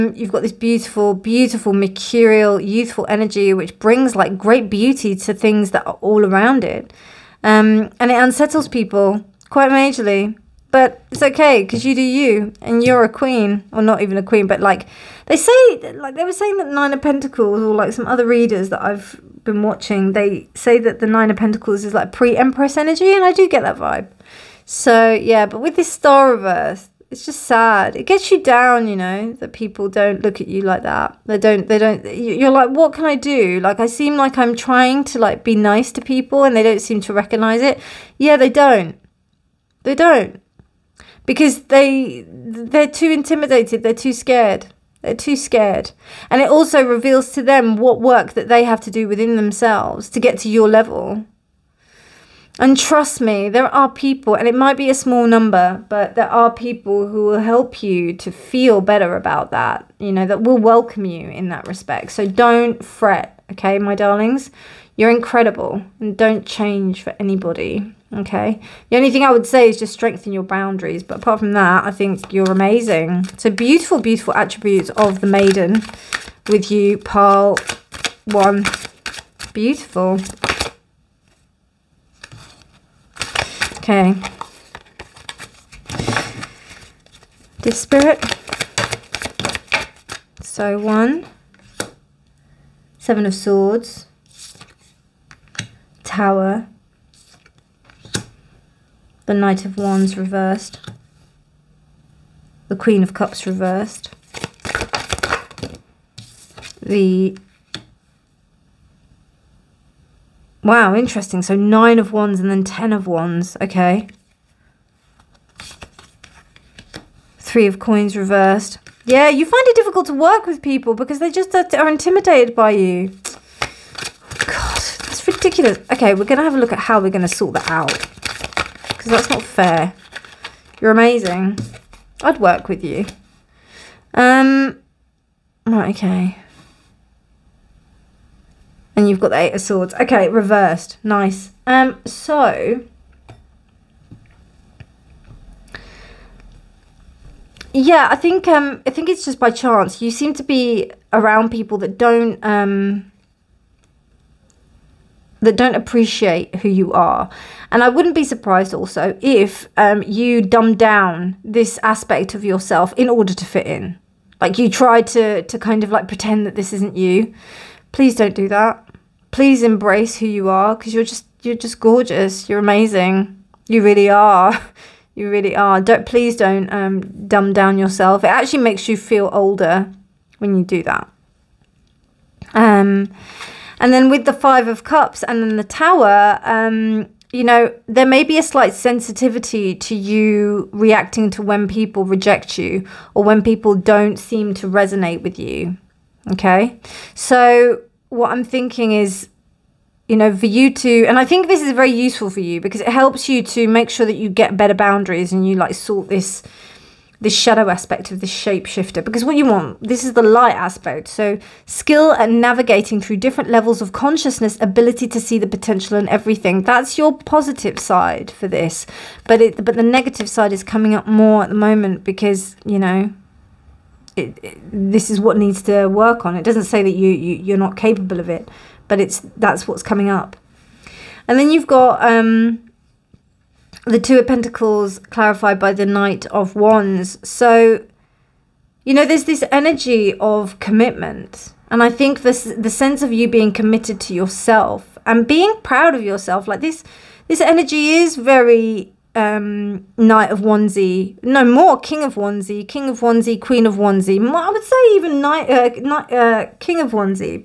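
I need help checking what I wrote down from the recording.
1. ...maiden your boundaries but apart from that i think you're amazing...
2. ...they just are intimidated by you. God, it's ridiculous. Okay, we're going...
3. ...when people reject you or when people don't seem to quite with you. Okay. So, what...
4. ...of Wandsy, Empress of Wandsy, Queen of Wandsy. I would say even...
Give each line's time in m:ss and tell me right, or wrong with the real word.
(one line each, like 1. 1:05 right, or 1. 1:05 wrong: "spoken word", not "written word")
1. 1:09 wrong: "strengthen", not "maiden"
2. 2:01 right
3. 3:11 wrong: "resonate", not "quite"
4. 4:12 wrong: "King", not "Empress".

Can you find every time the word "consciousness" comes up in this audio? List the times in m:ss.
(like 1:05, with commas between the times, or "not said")
3:33.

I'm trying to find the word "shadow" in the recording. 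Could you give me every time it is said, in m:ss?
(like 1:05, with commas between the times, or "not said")
3:27.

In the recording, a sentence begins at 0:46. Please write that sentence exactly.
And it also reveals to them what work that they have to do within themselves to get to your level.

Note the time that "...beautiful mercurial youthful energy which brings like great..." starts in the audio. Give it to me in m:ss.
0:01.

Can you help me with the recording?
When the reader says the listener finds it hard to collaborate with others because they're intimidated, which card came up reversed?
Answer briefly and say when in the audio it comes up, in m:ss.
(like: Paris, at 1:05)
Three of Coins, at 1:57.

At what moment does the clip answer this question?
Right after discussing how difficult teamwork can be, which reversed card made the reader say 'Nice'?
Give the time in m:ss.
2:19.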